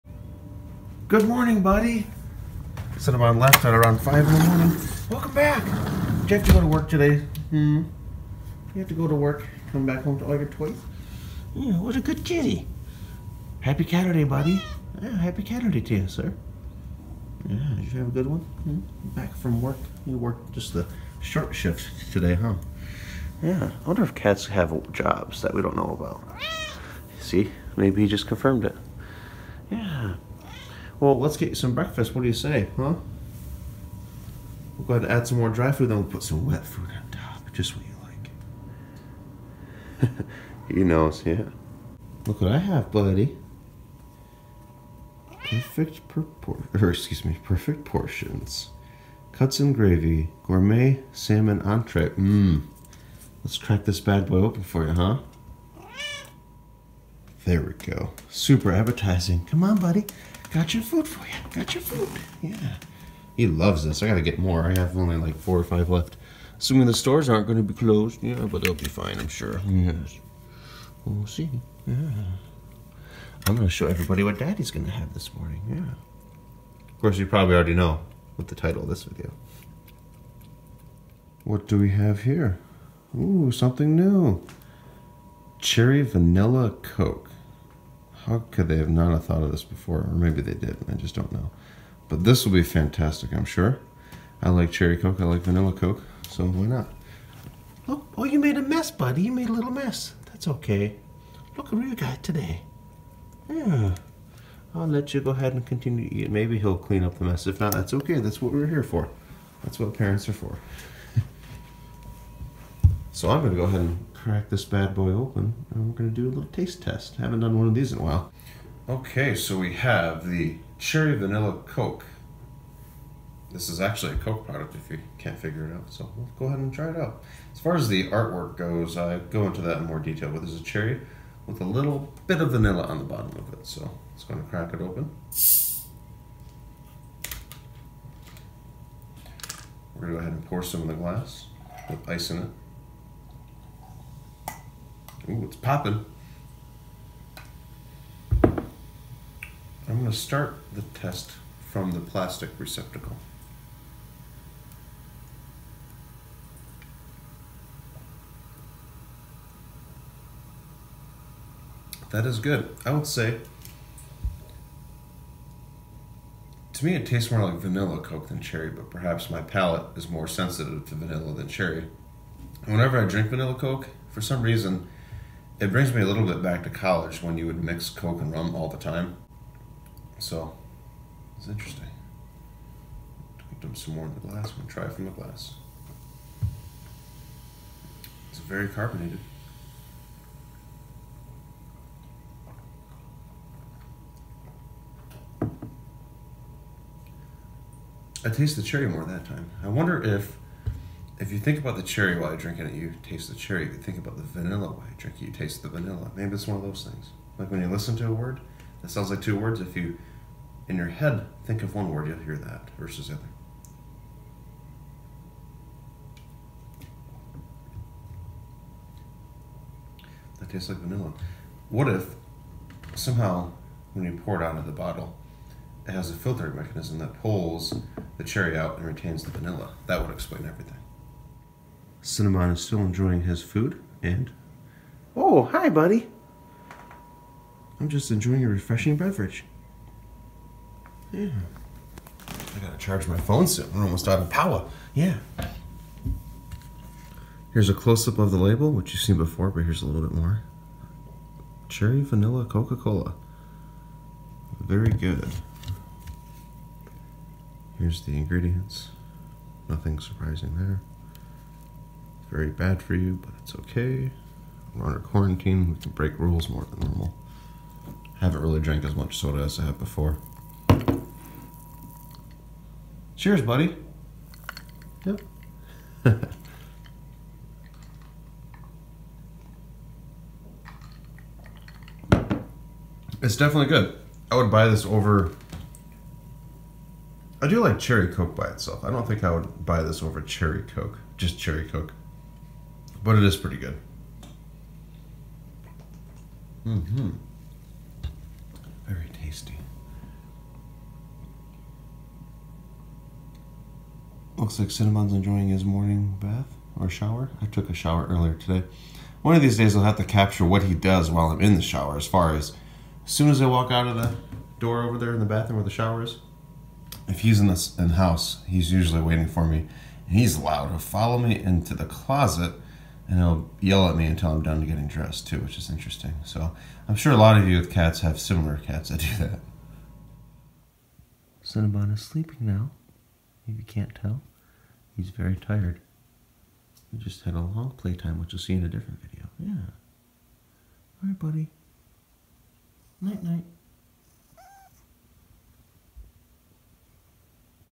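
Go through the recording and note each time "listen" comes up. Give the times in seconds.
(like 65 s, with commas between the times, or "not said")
207 s.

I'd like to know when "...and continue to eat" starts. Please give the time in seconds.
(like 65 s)
105 s.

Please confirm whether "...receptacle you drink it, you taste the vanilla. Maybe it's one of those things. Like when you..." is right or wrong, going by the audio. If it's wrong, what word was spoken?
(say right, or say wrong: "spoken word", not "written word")
wrong: "while", not "receptacle".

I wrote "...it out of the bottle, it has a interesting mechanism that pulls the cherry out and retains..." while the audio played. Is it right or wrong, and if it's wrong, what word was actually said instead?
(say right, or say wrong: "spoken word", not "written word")
wrong: "filtering", not "interesting".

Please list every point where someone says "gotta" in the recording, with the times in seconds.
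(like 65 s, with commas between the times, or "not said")
64 s, 242 s.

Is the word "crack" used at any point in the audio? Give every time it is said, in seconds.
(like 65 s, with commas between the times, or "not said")
53 s, 114 s, 134 s.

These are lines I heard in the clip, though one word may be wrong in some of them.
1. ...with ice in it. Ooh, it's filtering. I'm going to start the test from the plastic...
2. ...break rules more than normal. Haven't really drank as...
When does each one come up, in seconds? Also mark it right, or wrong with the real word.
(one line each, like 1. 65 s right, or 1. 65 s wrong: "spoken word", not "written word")
1. 141 s wrong: "popping", not "filtering"
2. 265 s right.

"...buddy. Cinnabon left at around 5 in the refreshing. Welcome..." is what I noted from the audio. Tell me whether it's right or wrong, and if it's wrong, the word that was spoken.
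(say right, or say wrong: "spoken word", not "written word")
wrong: "morning", not "refreshing".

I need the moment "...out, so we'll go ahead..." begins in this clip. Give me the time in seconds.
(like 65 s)
125 s.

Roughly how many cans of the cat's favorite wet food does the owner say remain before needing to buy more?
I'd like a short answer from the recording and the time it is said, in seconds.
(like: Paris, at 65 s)
four or five, at 65 s.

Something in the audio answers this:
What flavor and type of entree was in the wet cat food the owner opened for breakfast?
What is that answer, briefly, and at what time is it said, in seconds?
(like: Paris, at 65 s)
gourmet salmon entree, at 50 s.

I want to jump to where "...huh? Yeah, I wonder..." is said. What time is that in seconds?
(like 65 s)
22 s.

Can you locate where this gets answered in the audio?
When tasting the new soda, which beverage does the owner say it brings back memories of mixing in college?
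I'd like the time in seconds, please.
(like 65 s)
177 s.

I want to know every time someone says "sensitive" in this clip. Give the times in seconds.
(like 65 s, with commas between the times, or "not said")
170 s.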